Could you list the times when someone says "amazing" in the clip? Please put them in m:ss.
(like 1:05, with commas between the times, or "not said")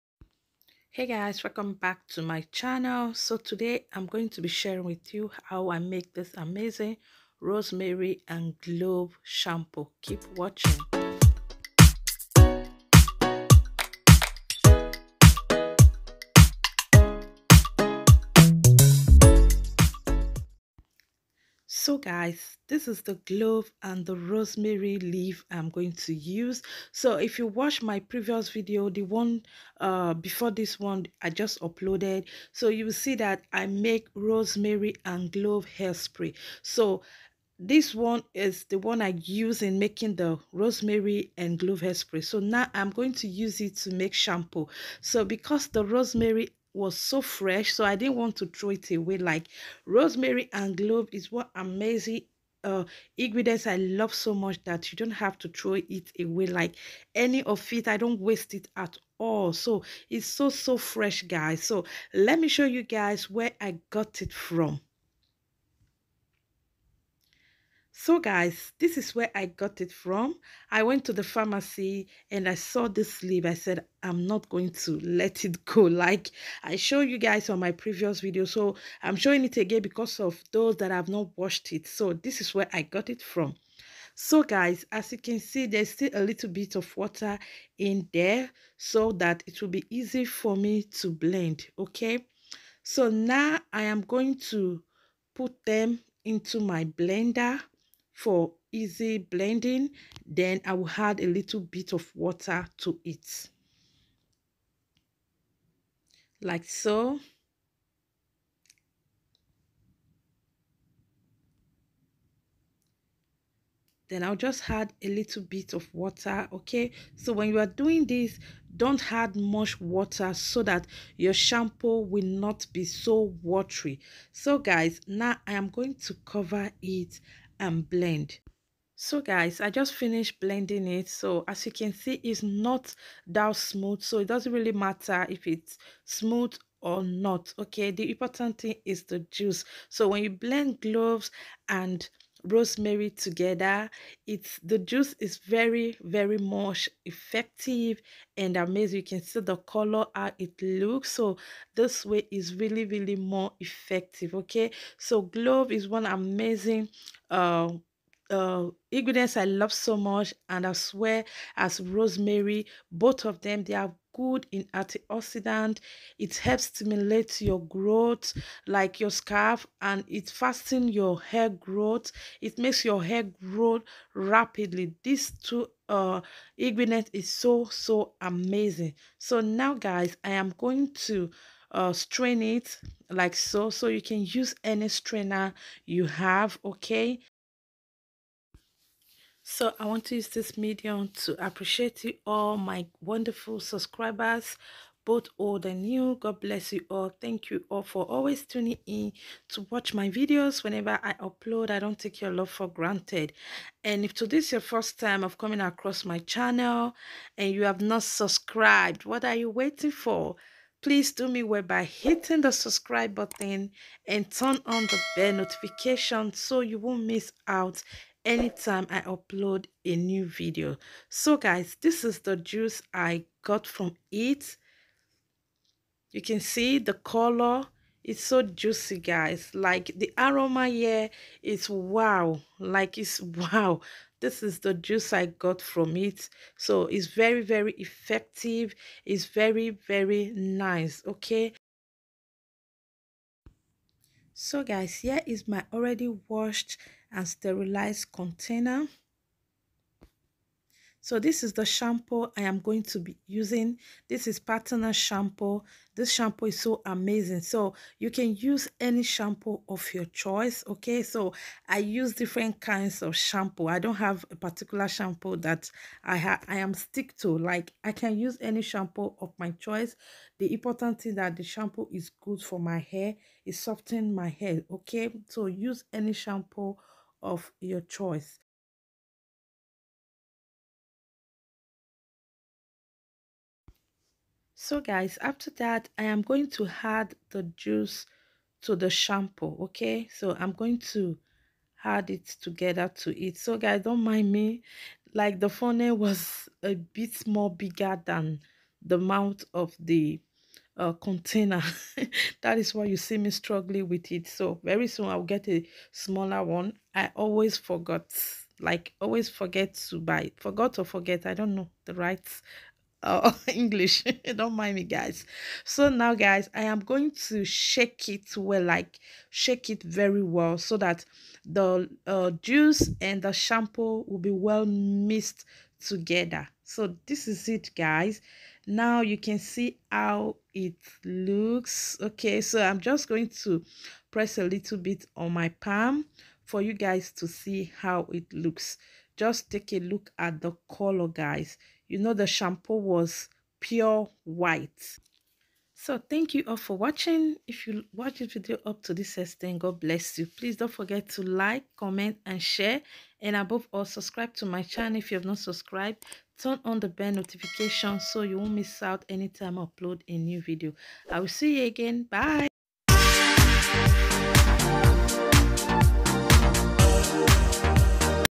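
0:06, 0:51, 2:28, 2:36, 2:58, 4:16.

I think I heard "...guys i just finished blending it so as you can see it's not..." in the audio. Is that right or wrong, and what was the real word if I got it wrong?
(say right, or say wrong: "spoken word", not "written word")
right.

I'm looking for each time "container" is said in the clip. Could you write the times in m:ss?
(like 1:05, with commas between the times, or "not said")
4:08, 5:00.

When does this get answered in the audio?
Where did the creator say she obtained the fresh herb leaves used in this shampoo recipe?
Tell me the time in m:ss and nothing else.
1:11.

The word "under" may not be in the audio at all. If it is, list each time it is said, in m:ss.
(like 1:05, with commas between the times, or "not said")
not said.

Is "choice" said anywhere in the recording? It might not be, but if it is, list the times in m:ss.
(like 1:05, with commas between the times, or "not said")
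4:20, 4:29, 4:37.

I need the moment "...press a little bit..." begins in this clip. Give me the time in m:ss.
5:34.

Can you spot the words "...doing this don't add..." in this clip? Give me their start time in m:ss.
1:57.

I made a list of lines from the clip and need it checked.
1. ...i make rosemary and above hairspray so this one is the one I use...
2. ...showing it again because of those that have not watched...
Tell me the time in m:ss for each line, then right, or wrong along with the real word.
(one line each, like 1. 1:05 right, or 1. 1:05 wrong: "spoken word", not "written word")
1. 0:33 wrong: "clove", not "above"
2. 1:19 right.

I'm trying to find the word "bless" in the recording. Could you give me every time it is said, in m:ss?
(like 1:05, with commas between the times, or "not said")
3:16, 5:49.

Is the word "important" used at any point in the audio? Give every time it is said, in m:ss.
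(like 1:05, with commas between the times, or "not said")
2:18, 4:30.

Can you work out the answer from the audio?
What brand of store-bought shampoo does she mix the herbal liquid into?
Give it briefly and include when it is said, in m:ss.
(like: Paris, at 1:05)
Partner Shampoo, at 4:14.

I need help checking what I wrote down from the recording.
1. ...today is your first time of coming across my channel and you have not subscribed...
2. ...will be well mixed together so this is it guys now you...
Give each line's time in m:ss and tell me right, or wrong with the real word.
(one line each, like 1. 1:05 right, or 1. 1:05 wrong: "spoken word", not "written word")
1. 3:24 right
2. 5:24 right.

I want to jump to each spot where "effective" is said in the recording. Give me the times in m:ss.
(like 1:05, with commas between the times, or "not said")
2:27, 2:33, 3:57.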